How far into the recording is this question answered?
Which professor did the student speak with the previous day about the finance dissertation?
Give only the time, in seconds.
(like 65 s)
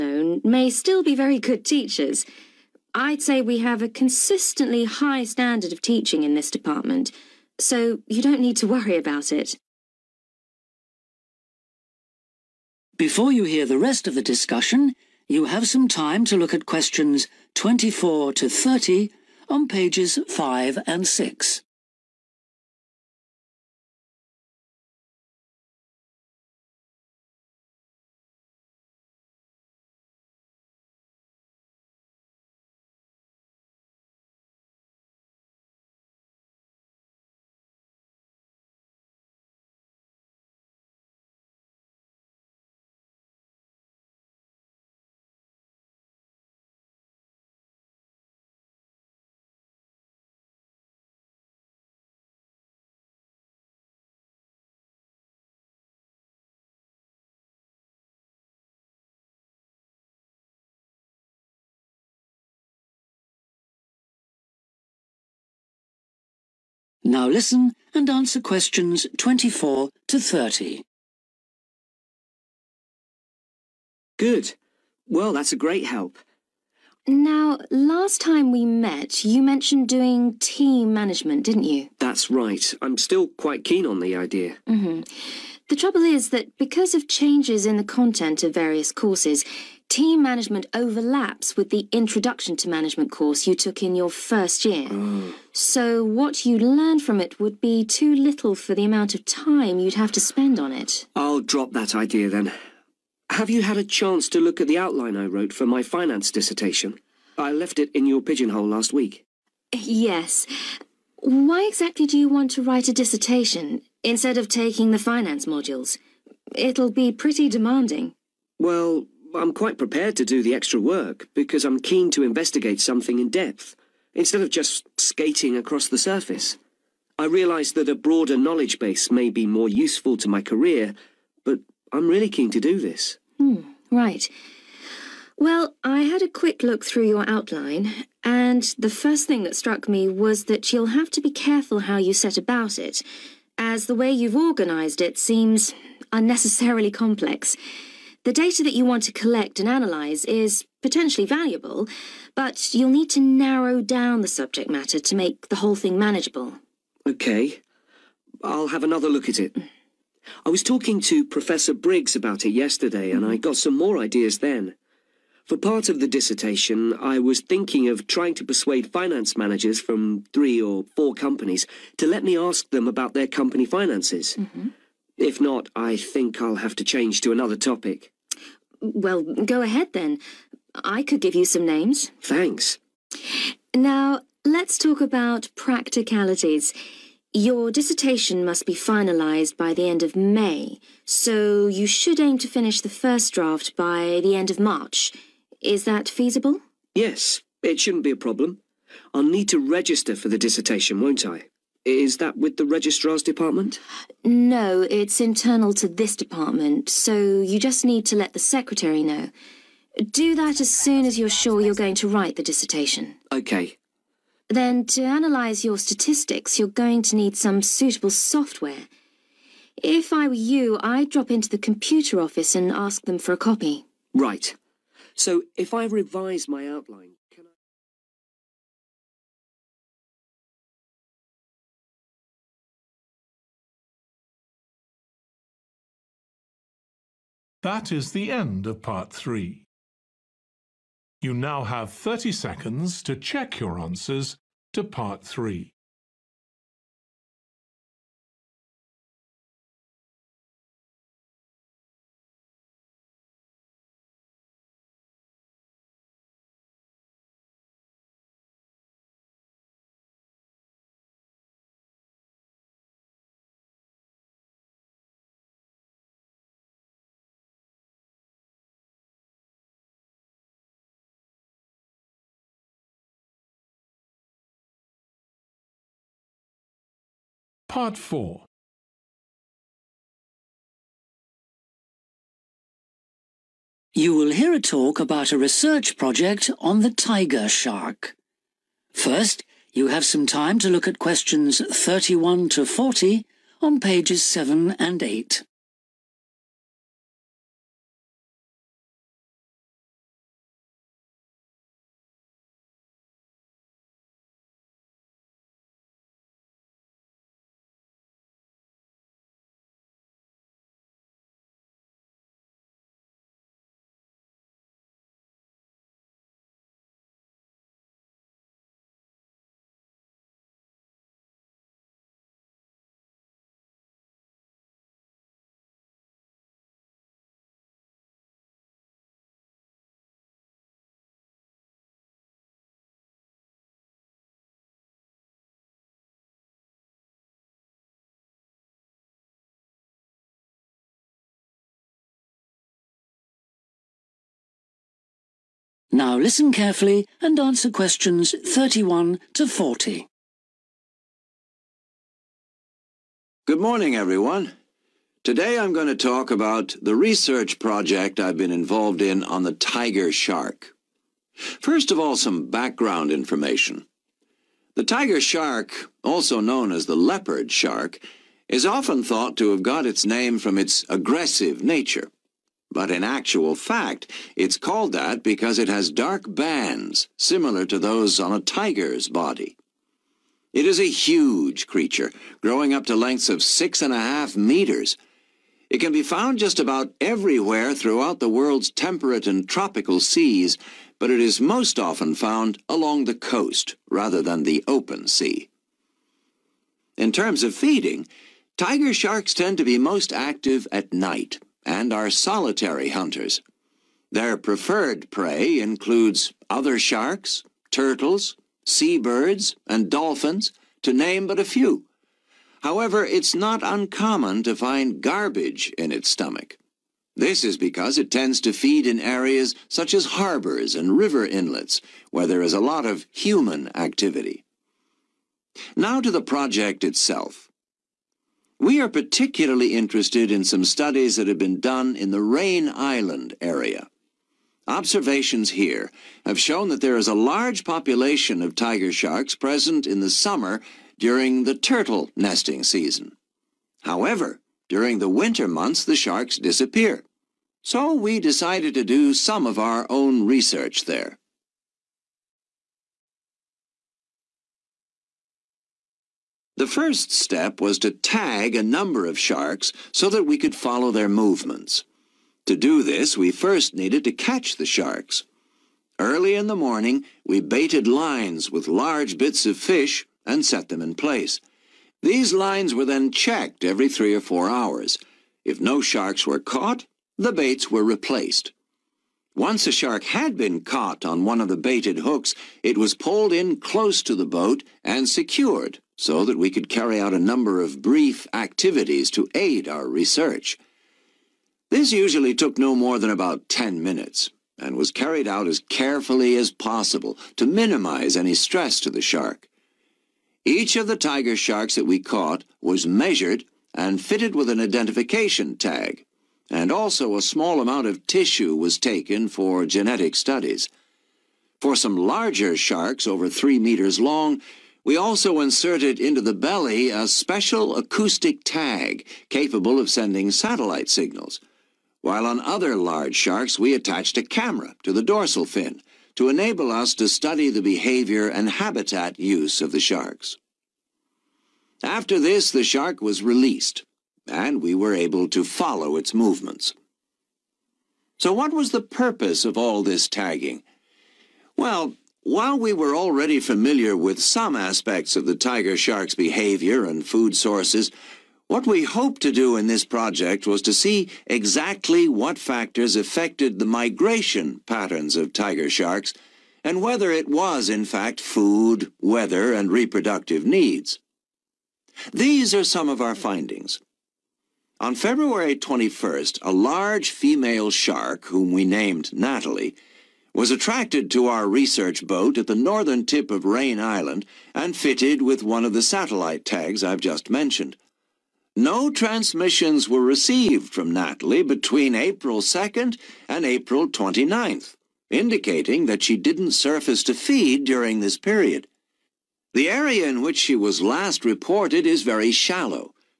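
161 s.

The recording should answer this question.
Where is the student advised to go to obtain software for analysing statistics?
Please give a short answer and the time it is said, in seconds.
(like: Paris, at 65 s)
The computer office, at 221 s.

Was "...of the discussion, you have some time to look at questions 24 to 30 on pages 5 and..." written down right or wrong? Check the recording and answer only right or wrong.
right.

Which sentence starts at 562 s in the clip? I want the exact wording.
These are some of our findings.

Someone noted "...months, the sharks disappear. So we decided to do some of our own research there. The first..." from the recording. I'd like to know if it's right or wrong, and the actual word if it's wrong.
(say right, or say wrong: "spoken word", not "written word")
right.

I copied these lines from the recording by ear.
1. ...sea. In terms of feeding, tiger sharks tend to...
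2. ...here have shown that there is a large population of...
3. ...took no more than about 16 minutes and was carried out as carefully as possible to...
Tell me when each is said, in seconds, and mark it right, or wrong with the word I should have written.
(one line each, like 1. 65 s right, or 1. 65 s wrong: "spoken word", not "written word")
1. 395 s right
2. 435 s right
3. 492 s wrong: "10", not "16".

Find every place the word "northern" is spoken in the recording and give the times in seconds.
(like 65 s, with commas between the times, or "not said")
572 s.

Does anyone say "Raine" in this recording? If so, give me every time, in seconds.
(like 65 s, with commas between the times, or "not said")
432 s, 573 s.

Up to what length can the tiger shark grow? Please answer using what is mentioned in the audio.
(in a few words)
6.5 meters.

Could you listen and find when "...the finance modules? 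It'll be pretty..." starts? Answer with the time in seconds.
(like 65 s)
114 s.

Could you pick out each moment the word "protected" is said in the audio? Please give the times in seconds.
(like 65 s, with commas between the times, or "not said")
not said.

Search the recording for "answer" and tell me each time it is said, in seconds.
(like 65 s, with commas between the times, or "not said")
68 s, 243 s, 347 s.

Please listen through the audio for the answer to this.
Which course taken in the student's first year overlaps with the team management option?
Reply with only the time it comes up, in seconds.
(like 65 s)
91 s.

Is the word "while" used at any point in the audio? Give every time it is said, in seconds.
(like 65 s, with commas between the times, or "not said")
522 s, 542 s.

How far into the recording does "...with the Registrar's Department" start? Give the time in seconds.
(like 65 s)
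202 s.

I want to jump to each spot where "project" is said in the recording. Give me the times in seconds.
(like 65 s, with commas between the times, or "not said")
285 s, 357 s, 426 s, 549 s.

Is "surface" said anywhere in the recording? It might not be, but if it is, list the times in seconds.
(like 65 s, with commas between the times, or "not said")
125 s, 586 s.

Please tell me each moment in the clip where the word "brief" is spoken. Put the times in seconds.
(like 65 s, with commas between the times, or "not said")
487 s.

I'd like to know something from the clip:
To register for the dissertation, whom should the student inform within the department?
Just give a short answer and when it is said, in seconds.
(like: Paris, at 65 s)
The secretary, at 208 s.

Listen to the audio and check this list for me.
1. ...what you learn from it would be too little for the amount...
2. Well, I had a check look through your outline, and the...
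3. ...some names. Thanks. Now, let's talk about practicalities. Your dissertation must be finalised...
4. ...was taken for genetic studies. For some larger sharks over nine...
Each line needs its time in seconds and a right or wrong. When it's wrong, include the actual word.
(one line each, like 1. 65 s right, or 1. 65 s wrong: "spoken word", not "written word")
1. 96 s right
2. 135 s wrong: "quick", not "check"
3. 181 s right
4. 508 s wrong: "three", not "nine".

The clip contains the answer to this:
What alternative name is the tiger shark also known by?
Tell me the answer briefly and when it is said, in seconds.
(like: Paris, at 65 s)
Leopard shark, at 366 s.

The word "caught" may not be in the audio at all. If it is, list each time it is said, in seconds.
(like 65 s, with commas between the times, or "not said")
476 s, 480 s, 501 s.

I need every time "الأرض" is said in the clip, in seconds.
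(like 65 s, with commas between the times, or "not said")
not said.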